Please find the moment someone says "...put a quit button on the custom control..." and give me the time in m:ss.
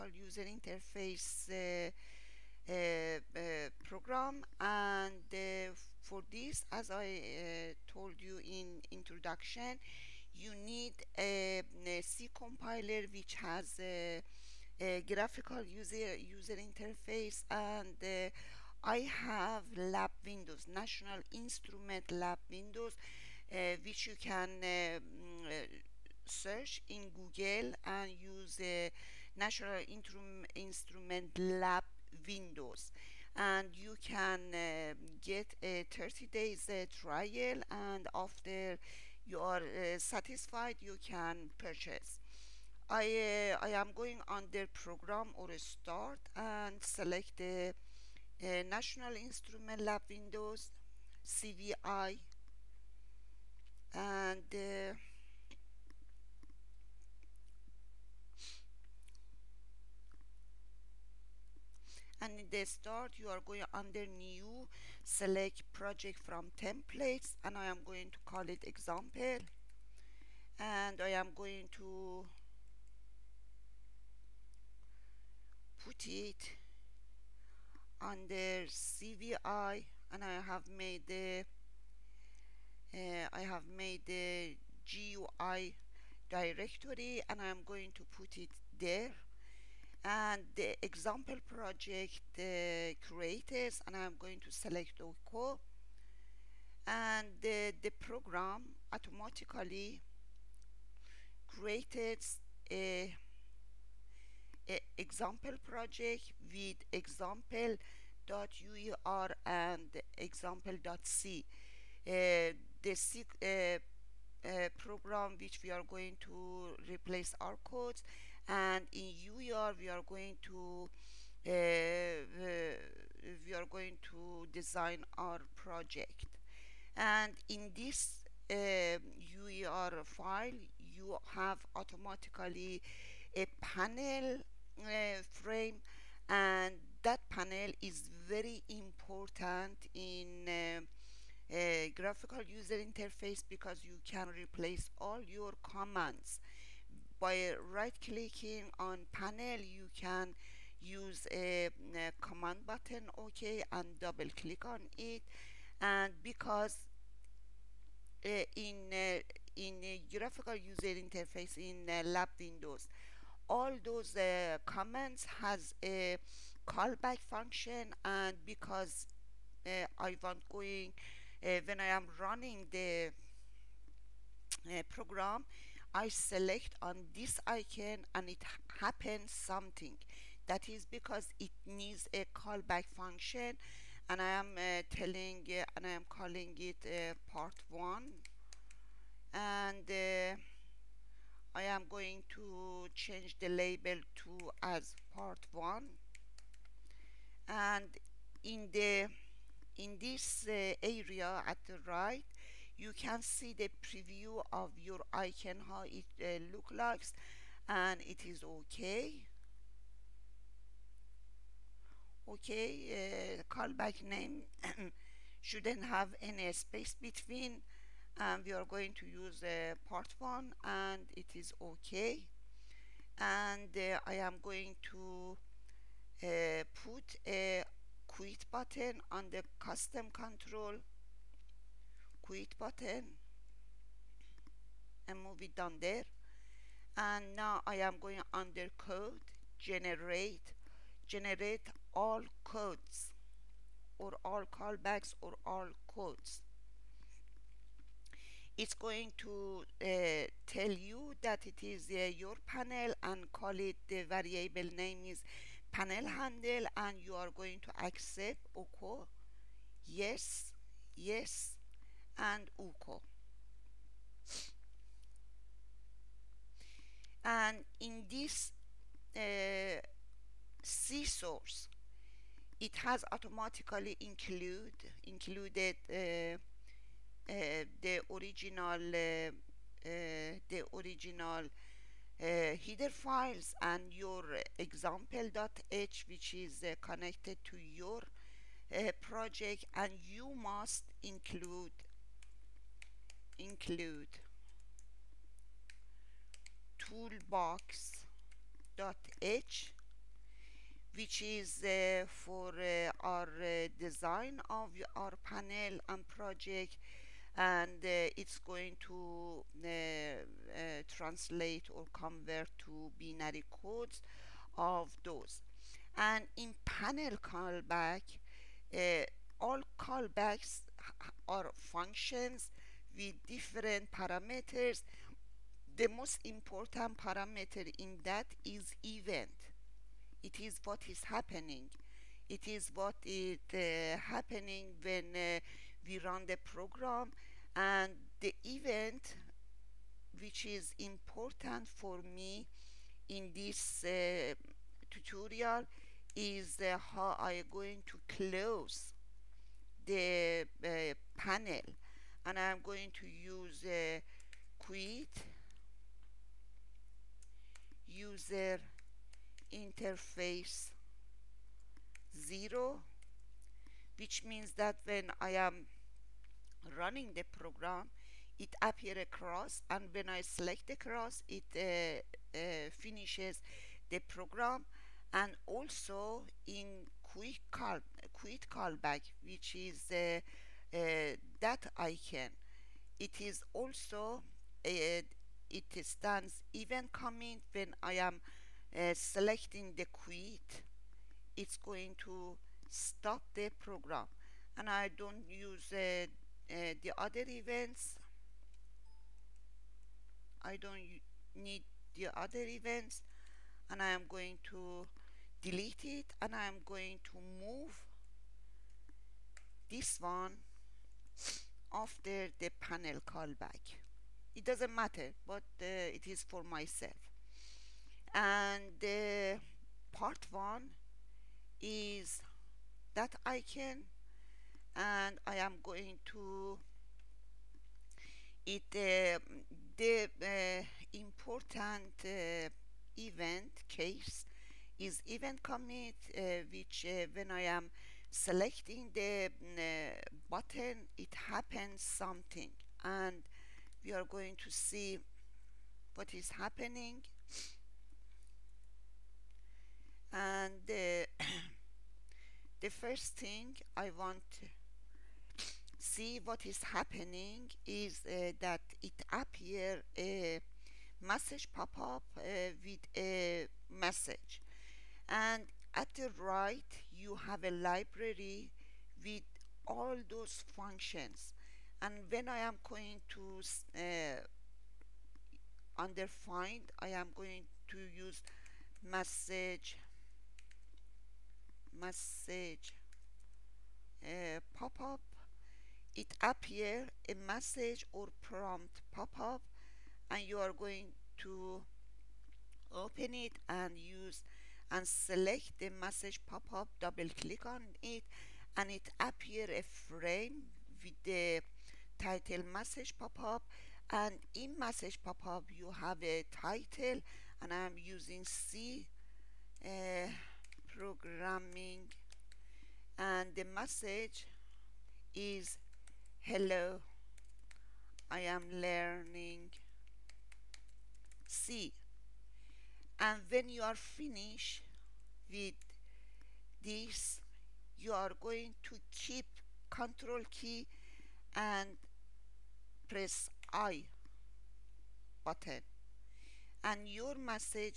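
3:46.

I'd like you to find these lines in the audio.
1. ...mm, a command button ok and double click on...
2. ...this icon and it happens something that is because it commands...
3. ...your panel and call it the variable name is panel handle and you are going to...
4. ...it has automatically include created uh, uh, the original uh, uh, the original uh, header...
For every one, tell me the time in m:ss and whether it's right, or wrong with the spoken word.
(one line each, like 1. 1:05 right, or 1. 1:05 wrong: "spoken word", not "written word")
1. 2:31 right
2. 2:57 wrong: "needs", not "commands"
3. 4:12 right
4. 4:32 wrong: "included", not "created".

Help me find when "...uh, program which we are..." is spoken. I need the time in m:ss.
1:54.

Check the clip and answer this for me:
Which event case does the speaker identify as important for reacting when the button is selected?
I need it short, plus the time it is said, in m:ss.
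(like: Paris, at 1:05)
event commit, at 7:15.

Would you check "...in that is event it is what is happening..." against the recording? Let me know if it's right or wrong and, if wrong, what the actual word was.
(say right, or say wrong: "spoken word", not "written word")
right.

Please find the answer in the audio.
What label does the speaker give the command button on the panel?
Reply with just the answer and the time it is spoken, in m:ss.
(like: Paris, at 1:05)
part 1, at 3:12.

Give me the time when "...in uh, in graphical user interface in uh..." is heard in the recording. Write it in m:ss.
2:38.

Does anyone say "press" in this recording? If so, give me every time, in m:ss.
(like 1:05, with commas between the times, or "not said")
8:52.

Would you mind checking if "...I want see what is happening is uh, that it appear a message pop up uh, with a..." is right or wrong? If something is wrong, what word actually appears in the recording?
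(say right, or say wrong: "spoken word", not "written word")
right.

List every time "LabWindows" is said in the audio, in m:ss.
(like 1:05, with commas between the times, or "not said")
0:49.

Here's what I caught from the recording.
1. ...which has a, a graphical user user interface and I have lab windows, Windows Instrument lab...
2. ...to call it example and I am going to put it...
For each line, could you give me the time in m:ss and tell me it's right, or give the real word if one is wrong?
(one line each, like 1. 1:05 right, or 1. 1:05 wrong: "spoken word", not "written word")
1. 0:13 wrong: "National", not "Windows"
2. 1:08 right.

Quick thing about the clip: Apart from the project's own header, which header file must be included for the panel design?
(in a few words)
toolbox.h.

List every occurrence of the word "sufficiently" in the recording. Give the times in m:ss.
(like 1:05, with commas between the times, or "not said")
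not said.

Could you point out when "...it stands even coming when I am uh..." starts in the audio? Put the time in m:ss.
6:25.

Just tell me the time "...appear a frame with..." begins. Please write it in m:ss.
8:19.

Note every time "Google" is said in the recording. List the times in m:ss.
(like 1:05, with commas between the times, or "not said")
0:27.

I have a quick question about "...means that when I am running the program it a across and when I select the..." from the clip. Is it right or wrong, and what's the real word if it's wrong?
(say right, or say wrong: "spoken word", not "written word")
right.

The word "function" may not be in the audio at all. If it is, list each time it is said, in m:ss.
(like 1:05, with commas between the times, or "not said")
2:47, 3:02, 5:21, 7:50.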